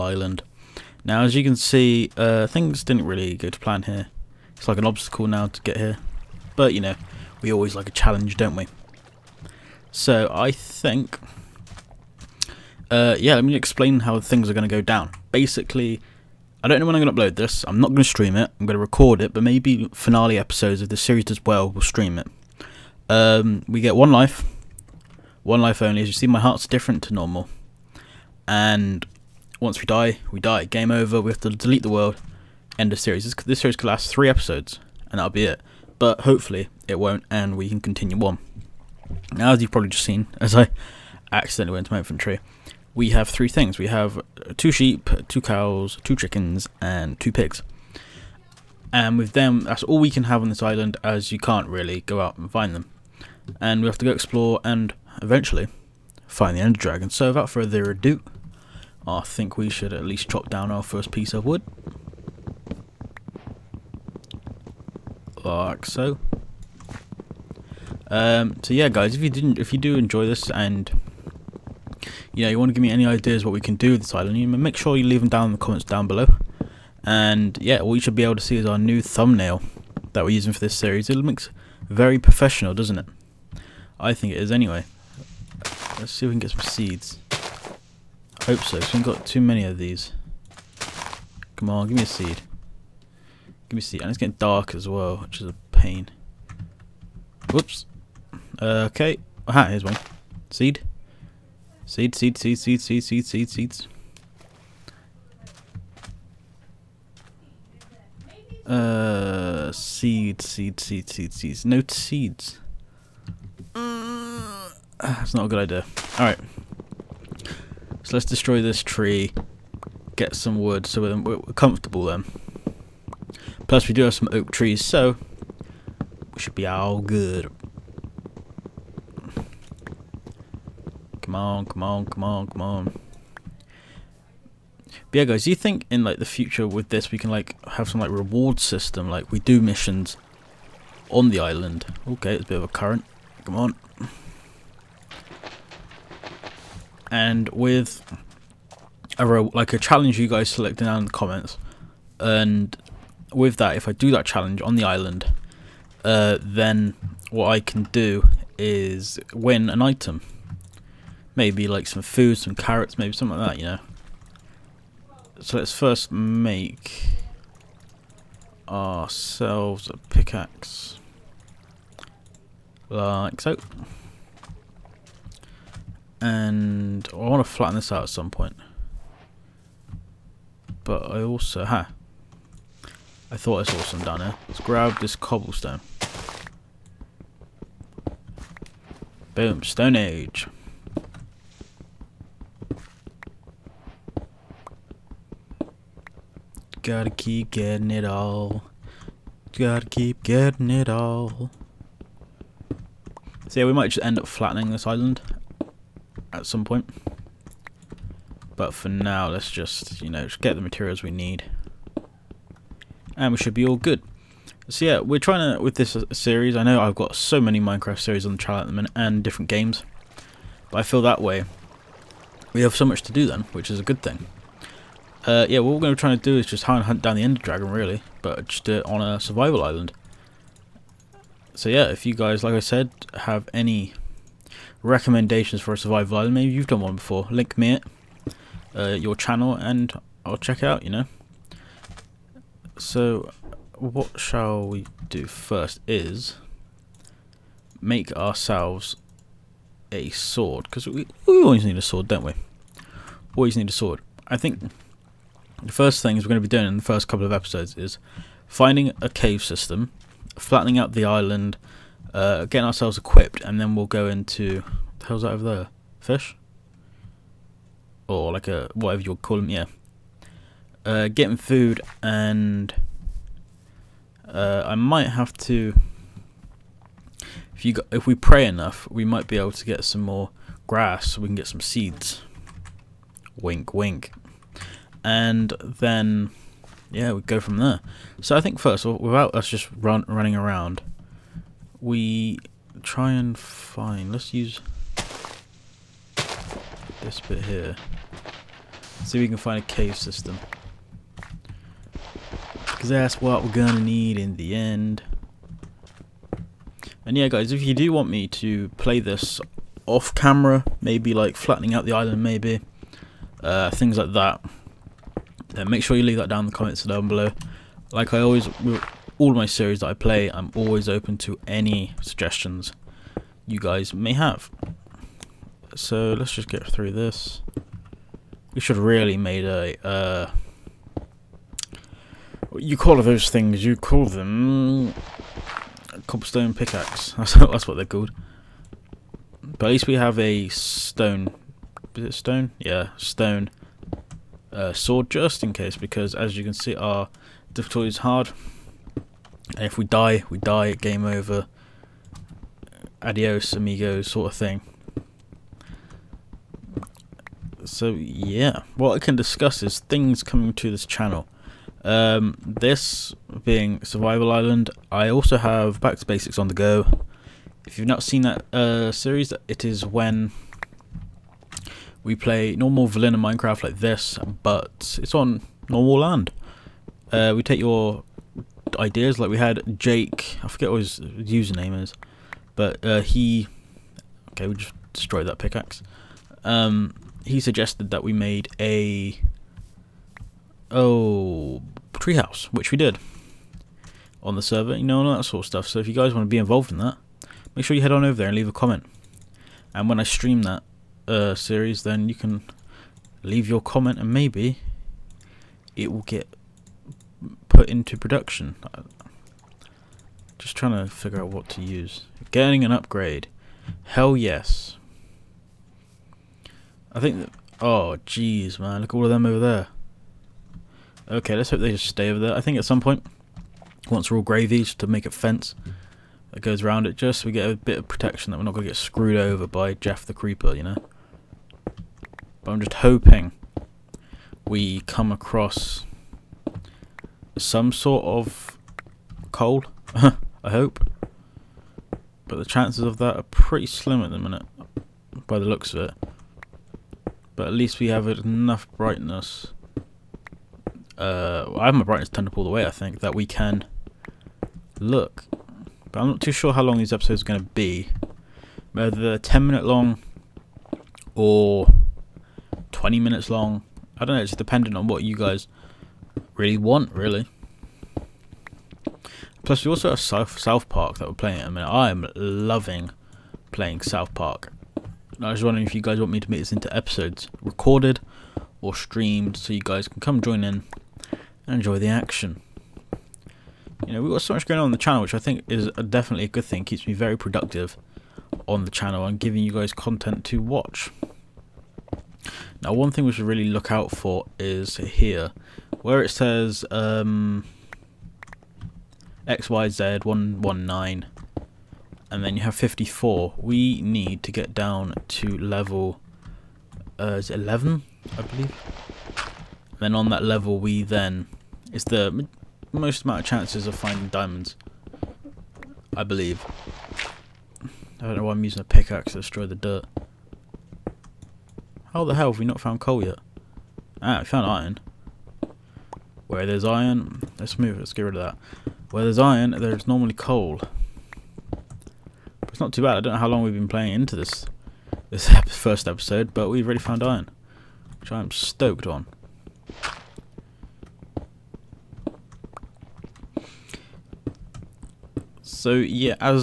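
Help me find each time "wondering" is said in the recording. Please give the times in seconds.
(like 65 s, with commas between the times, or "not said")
475 s.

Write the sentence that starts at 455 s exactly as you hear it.
But I'm not too sure how long these episodes are going to be.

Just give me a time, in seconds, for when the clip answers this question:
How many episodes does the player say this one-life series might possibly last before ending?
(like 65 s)
34 s.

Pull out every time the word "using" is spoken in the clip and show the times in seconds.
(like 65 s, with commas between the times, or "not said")
80 s, 518 s.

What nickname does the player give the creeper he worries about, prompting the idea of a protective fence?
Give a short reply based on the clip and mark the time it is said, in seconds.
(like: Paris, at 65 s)
Jeff the Creeper, at 429 s.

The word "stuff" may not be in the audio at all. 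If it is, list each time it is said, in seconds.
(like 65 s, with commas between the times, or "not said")
395 s.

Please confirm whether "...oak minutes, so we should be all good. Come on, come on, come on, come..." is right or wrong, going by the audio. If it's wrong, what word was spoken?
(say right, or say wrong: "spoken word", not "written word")
wrong: "trees", not "minutes".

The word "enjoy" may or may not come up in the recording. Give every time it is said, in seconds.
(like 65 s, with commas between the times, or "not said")
69 s, 481 s.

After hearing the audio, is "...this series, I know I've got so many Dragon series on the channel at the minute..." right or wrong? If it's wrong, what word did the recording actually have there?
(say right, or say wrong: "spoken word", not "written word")
wrong: "Minecraft", not "Dragon".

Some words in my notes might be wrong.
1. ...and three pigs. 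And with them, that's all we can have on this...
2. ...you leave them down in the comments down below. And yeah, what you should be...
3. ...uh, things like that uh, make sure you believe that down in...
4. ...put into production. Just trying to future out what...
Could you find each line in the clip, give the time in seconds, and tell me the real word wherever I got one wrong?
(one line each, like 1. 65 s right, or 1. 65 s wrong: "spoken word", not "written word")
1. 46 s wrong: "two", not "three"
2. 74 s right
3. 313 s wrong: "leave", not "believe"
4. 407 s wrong: "figure", not "future".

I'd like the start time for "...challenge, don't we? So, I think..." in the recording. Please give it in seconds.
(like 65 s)
7 s.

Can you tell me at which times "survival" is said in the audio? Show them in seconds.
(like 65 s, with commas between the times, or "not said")
229 s, 235 s, 363 s.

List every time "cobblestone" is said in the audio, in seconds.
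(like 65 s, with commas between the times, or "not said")
185 s, 336 s.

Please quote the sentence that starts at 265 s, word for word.
Fish, or like a whatever you would call them, yeah.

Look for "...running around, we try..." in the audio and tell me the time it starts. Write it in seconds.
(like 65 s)
290 s.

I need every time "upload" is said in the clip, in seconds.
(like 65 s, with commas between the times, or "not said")
17 s.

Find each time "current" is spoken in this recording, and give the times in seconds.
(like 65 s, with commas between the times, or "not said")
142 s.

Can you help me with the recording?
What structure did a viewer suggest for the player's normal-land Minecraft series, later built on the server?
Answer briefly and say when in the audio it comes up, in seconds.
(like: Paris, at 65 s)
treehouse, at 391 s.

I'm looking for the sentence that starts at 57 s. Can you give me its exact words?
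So without further ado, I think we should at least chop down our first piece of wood.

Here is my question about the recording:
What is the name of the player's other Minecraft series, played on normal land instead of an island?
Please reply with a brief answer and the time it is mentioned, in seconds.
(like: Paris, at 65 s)
Back to Basics, at 365 s.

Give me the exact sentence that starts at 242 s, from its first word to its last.
So, what shall we do first is make ourselves a sword, because we, we always need a sword, don't we?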